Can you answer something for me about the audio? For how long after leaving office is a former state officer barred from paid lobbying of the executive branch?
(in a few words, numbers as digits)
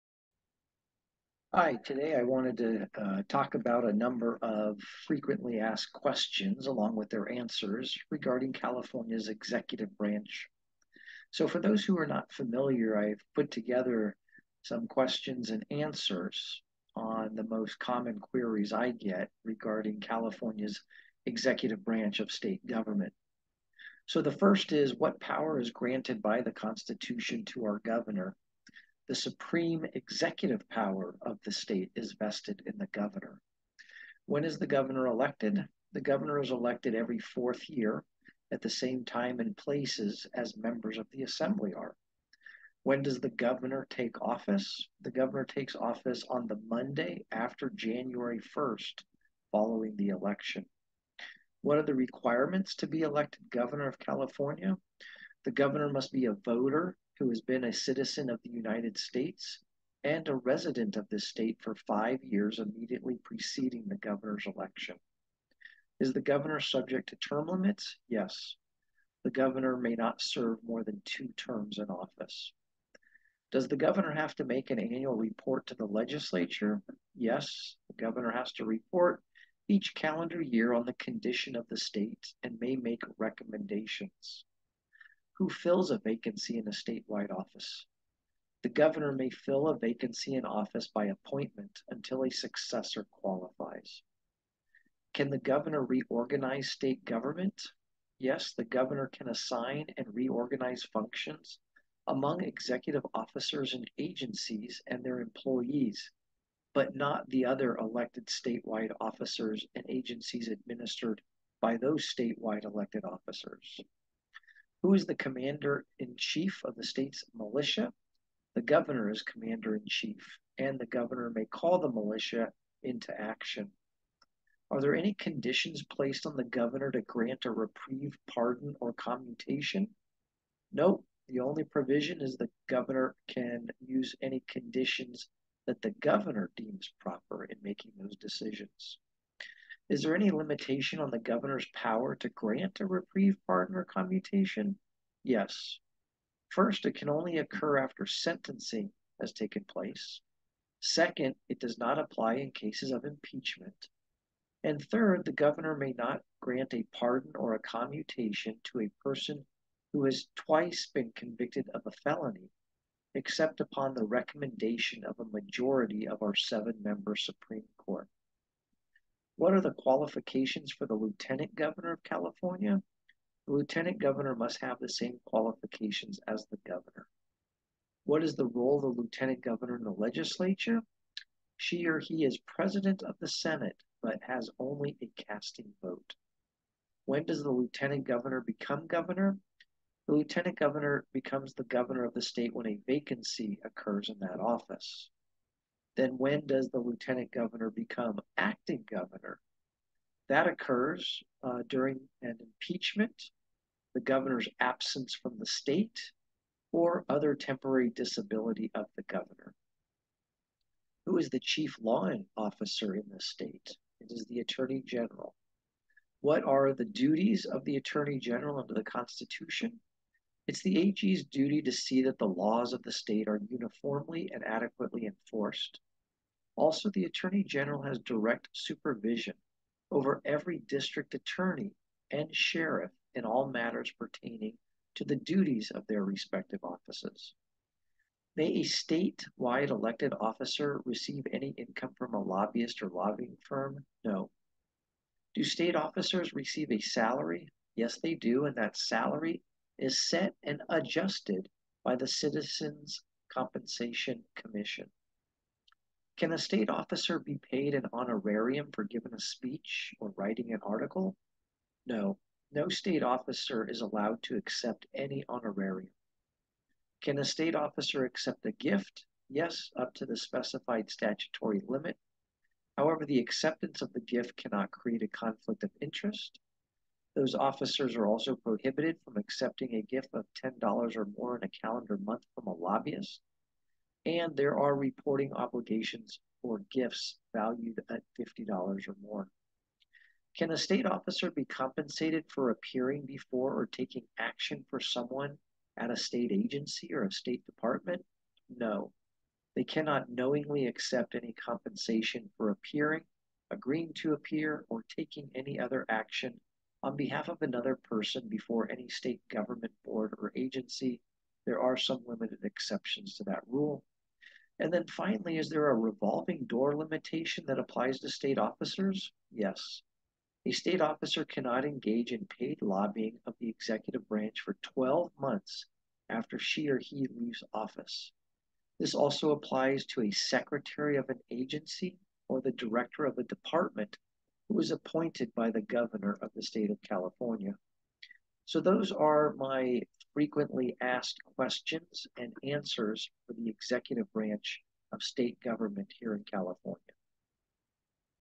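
12 months.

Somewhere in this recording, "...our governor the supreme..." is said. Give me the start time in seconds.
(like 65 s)
27 s.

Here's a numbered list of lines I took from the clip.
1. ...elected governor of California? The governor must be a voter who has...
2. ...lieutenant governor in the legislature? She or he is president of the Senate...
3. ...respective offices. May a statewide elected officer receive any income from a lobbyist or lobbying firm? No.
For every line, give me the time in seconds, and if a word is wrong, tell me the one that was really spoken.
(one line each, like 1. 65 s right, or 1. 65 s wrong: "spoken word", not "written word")
1. 53 s right
2. 179 s right
3. 236 s right.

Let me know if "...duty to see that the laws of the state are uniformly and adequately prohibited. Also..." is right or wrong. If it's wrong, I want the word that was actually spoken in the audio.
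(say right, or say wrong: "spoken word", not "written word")
wrong: "enforced", not "prohibited".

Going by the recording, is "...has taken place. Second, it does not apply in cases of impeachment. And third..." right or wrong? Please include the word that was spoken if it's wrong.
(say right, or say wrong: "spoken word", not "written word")
right.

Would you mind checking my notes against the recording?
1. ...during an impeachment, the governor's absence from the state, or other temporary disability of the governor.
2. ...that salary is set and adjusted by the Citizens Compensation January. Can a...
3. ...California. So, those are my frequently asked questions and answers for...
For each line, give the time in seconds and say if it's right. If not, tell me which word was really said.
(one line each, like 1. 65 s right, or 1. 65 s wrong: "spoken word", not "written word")
1. 201 s right
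2. 248 s wrong: "Commission", not "January"
3. 336 s right.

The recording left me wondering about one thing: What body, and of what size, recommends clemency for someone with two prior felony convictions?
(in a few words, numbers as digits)
7-member Supreme Court.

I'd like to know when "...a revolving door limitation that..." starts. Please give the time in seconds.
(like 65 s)
315 s.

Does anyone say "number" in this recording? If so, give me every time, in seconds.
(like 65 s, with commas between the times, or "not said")
3 s.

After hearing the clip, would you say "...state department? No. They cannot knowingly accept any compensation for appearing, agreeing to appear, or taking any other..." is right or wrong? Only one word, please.
right.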